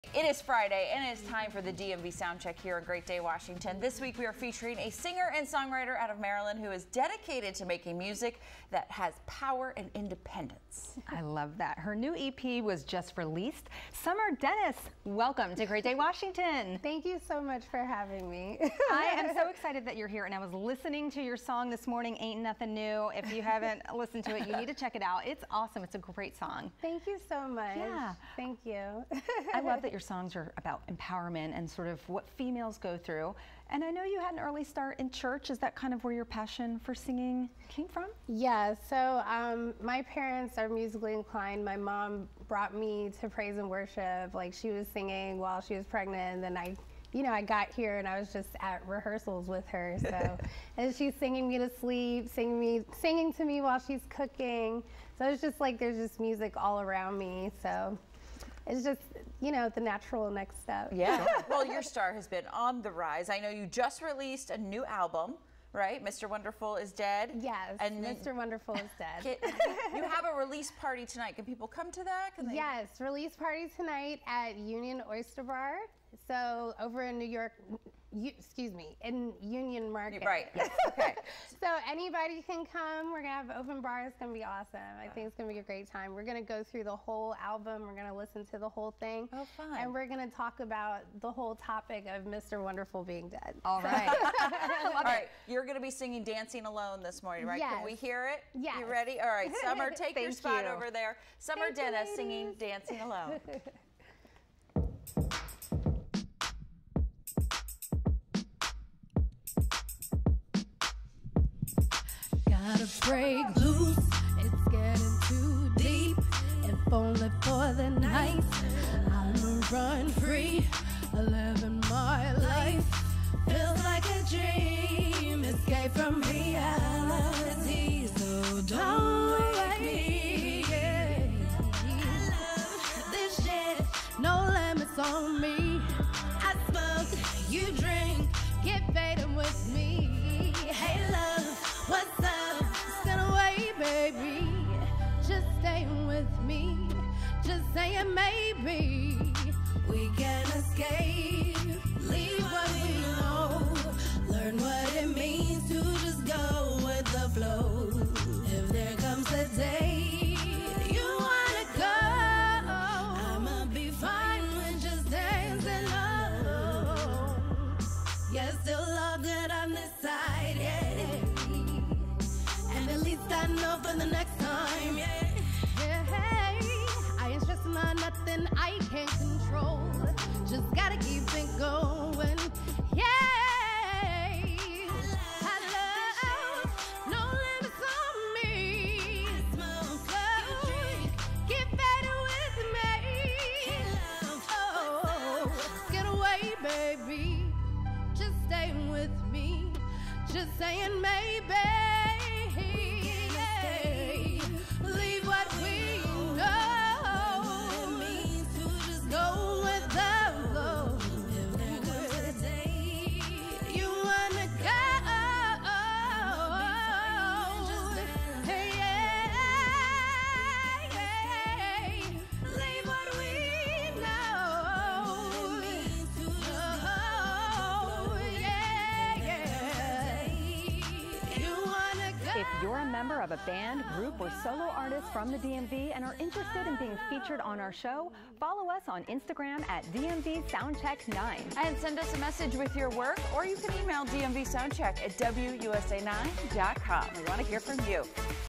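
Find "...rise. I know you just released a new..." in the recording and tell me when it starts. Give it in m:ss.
1:02.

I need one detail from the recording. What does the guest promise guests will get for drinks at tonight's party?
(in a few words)
Open bar.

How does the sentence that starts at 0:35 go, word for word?
Is that kind of where your passion for singing came from?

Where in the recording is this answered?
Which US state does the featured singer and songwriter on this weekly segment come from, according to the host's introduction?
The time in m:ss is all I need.
0:06.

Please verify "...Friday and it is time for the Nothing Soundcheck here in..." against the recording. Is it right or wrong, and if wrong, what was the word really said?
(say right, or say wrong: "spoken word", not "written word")
wrong: "DMV", not "Nothing".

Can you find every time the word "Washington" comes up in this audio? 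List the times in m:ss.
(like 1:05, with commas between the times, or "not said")
0:03, 0:15.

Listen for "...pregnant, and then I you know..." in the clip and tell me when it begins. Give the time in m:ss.
0:45.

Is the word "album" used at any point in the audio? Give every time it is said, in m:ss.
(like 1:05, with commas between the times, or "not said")
1:04, 1:27.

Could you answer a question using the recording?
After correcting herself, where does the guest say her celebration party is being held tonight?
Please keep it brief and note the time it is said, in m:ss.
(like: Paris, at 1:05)
Union Market, at 1:19.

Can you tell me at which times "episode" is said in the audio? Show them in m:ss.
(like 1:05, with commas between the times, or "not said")
not said.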